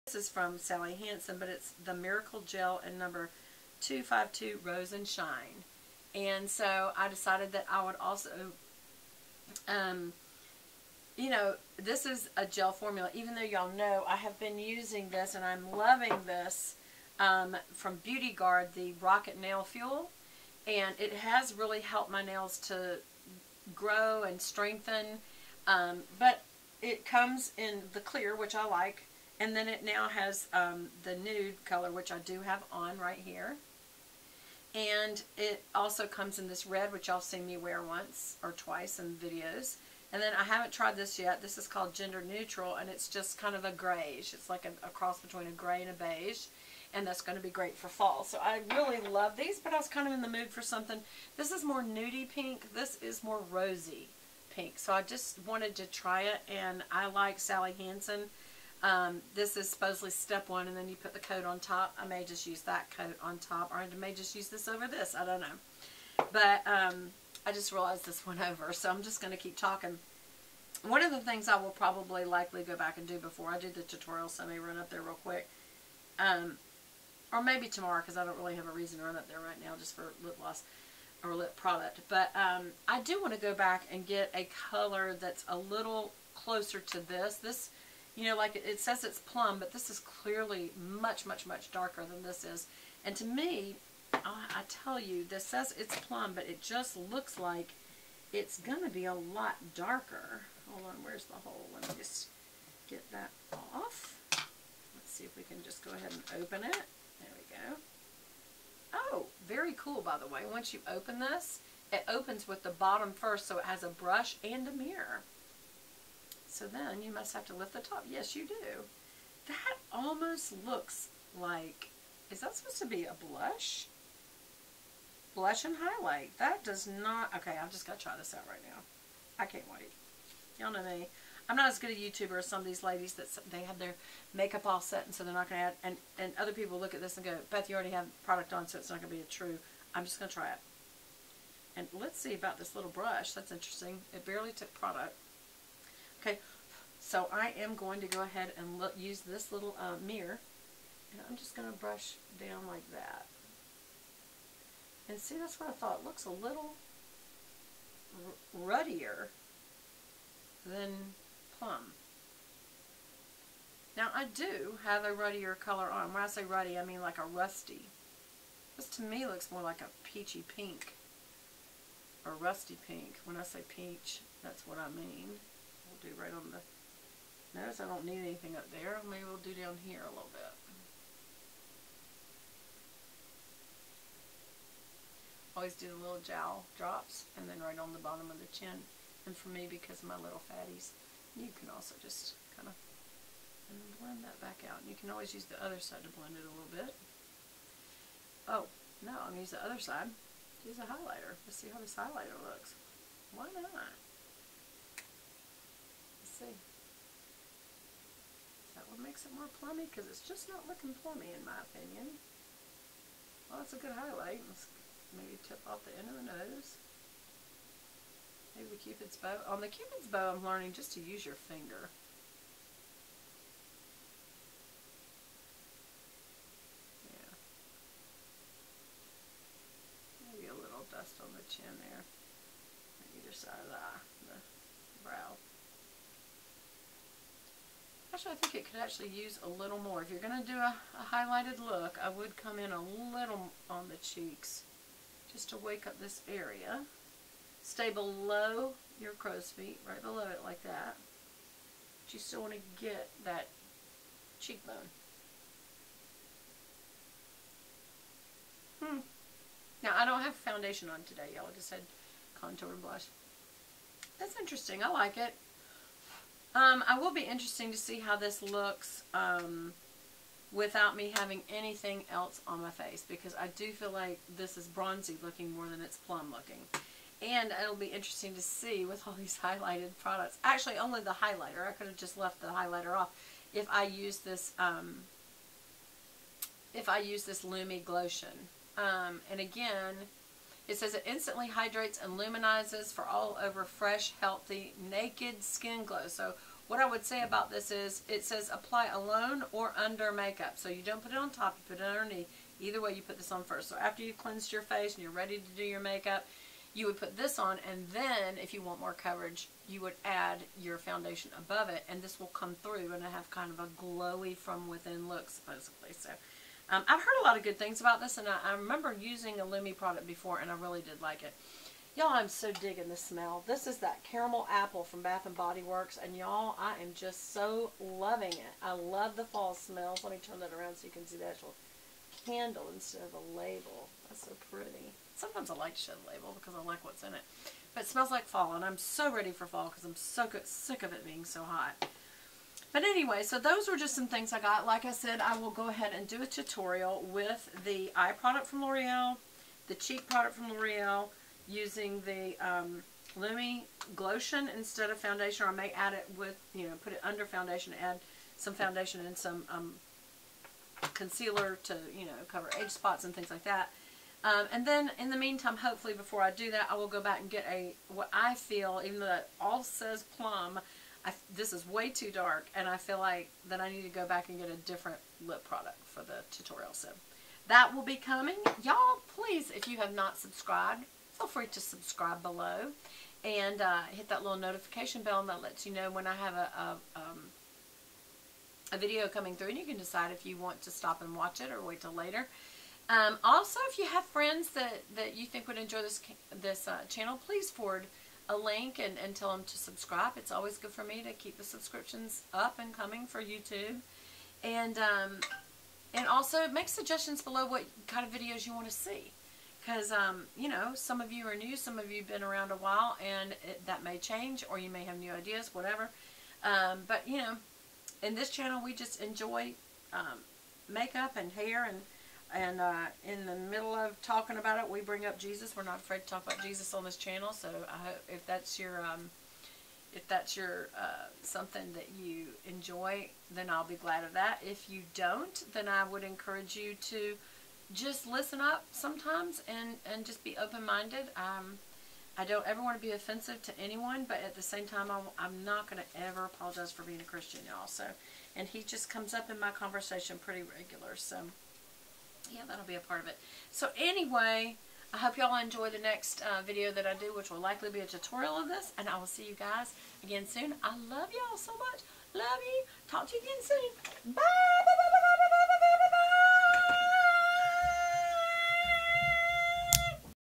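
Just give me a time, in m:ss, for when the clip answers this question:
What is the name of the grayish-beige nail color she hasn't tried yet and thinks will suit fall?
0:41.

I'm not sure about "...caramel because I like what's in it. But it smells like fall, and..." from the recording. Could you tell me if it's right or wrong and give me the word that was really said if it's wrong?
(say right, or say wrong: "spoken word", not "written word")
wrong: "label", not "caramel".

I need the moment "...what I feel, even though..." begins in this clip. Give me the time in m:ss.
6:07.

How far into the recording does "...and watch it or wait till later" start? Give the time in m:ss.
6:31.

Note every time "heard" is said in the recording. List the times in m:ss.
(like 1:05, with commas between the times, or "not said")
5:17.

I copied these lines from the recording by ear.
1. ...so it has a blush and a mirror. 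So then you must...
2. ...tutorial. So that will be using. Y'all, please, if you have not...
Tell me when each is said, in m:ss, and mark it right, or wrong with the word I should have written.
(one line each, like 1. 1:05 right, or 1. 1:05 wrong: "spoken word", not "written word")
1. 1:53 wrong: "brush", not "blush"
2. 6:16 wrong: "coming", not "using".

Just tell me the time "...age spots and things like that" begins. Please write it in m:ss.
6:02.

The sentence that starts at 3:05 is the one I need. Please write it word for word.
Always do the little jowl drops and then right on the bottom of the chin.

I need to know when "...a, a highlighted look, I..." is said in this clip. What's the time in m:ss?
4:00.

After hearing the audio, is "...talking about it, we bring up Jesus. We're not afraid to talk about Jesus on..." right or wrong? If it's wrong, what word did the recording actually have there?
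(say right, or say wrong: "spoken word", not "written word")
right.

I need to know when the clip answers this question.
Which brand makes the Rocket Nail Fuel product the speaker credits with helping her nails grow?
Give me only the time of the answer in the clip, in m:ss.
0:18.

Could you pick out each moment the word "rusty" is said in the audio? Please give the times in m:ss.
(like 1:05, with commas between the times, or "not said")
2:47, 2:52.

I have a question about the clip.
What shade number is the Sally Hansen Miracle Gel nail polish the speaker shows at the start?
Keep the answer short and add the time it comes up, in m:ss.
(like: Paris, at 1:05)
252, at 0:02.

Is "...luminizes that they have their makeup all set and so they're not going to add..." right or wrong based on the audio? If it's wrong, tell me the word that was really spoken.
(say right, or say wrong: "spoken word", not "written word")
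wrong: "ladies", not "luminizes".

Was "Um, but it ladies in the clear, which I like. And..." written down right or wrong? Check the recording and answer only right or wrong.
wrong.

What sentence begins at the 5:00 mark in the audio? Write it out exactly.
So you don't put it on top, you put it underneath.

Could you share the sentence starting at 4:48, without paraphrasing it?
Um, and again, it says it instantly hydrates and luminizes for all over fresh, healthy, naked skin glow.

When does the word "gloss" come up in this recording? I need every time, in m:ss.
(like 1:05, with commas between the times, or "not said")
1:20.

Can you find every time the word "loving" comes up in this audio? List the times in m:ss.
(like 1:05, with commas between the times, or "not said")
0:15, 5:27.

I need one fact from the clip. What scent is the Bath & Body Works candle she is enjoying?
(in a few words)
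Caramel apple.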